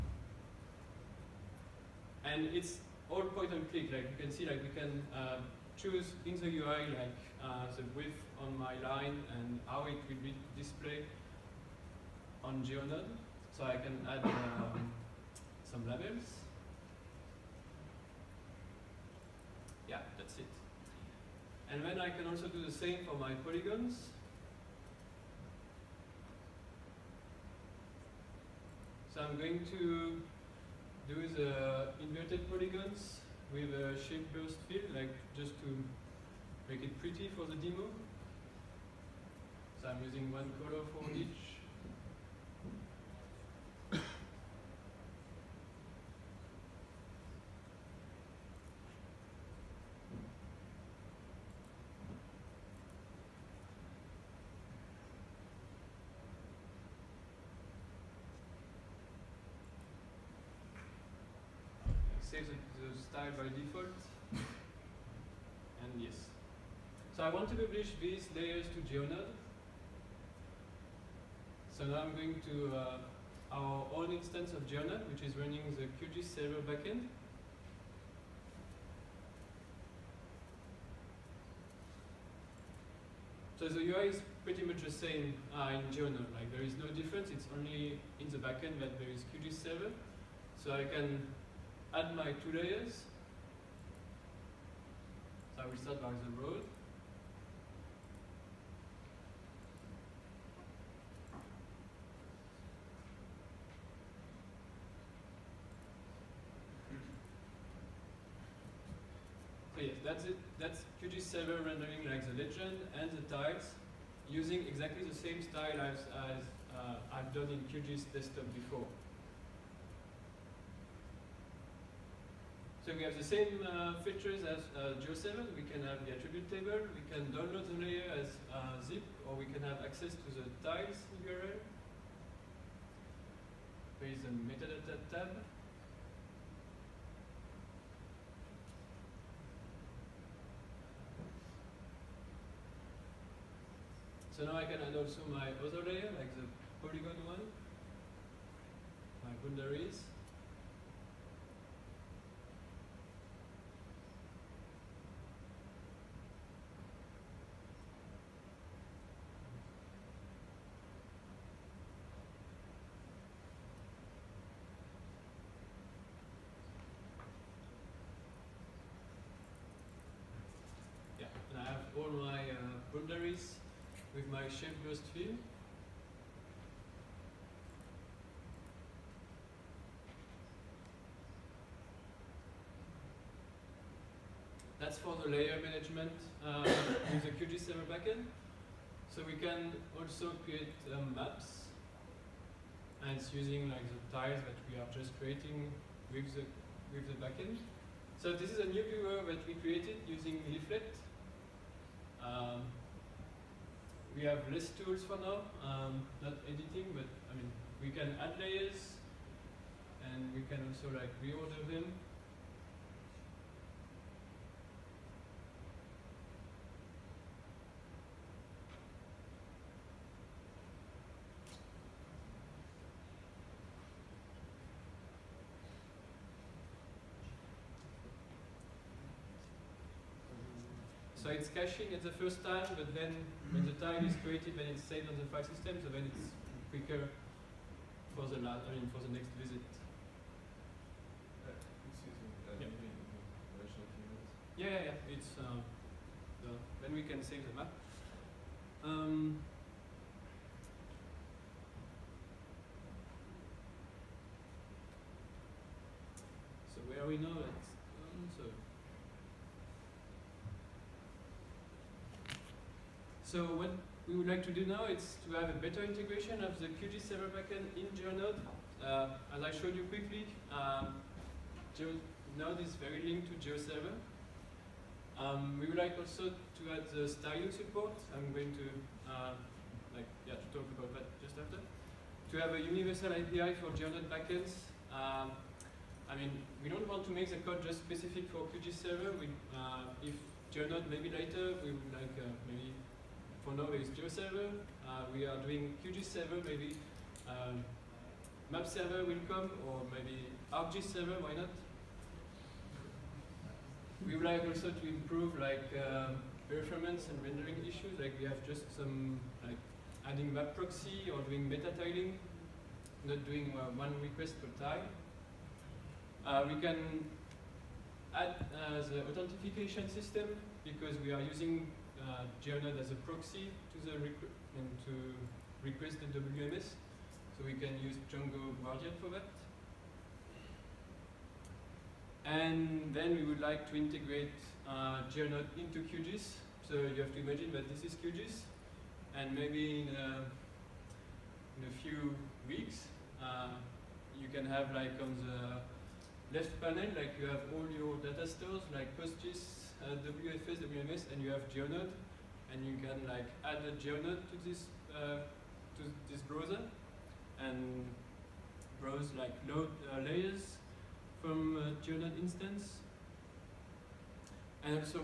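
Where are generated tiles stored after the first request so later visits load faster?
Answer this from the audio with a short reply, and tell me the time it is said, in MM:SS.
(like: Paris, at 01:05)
the file system, at 03:55.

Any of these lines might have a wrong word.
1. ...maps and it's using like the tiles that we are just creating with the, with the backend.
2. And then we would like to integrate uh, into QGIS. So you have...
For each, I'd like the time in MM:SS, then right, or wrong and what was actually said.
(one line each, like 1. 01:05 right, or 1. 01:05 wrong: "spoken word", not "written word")
1. 03:11 right
2. 05:32 right.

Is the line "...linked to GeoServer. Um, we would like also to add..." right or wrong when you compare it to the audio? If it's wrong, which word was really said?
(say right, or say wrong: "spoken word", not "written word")
right.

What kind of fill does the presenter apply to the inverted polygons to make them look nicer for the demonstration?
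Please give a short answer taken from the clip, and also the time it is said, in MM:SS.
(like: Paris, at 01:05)
shape burst fill, at 00:33.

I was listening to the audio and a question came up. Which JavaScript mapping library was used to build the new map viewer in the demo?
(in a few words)
Leaflet.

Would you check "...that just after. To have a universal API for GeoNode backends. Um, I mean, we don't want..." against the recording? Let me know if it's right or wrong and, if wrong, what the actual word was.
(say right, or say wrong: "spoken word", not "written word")
right.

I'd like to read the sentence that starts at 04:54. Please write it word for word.
Uh, we are doing QGIS server, maybe um, map server will come, or maybe ArcGIS server, why not?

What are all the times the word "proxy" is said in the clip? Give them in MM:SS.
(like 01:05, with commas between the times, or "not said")
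05:10, 05:23.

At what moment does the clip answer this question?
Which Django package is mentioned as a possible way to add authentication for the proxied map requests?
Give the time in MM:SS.
05:28.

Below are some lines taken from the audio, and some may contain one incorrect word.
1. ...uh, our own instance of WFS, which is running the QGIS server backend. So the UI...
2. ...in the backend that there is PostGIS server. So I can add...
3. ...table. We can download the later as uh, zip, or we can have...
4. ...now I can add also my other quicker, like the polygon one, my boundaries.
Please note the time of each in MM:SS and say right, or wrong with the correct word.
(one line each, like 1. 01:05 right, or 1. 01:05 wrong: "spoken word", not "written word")
1. 01:12 wrong: "GeoNode", not "WFS"
2. 01:28 wrong: "QGIS", not "PostGIS"
3. 02:06 wrong: "layer", not "later"
4. 02:24 wrong: "layer", not "quicker".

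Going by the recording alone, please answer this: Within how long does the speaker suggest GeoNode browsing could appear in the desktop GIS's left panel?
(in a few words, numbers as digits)
a few weeks.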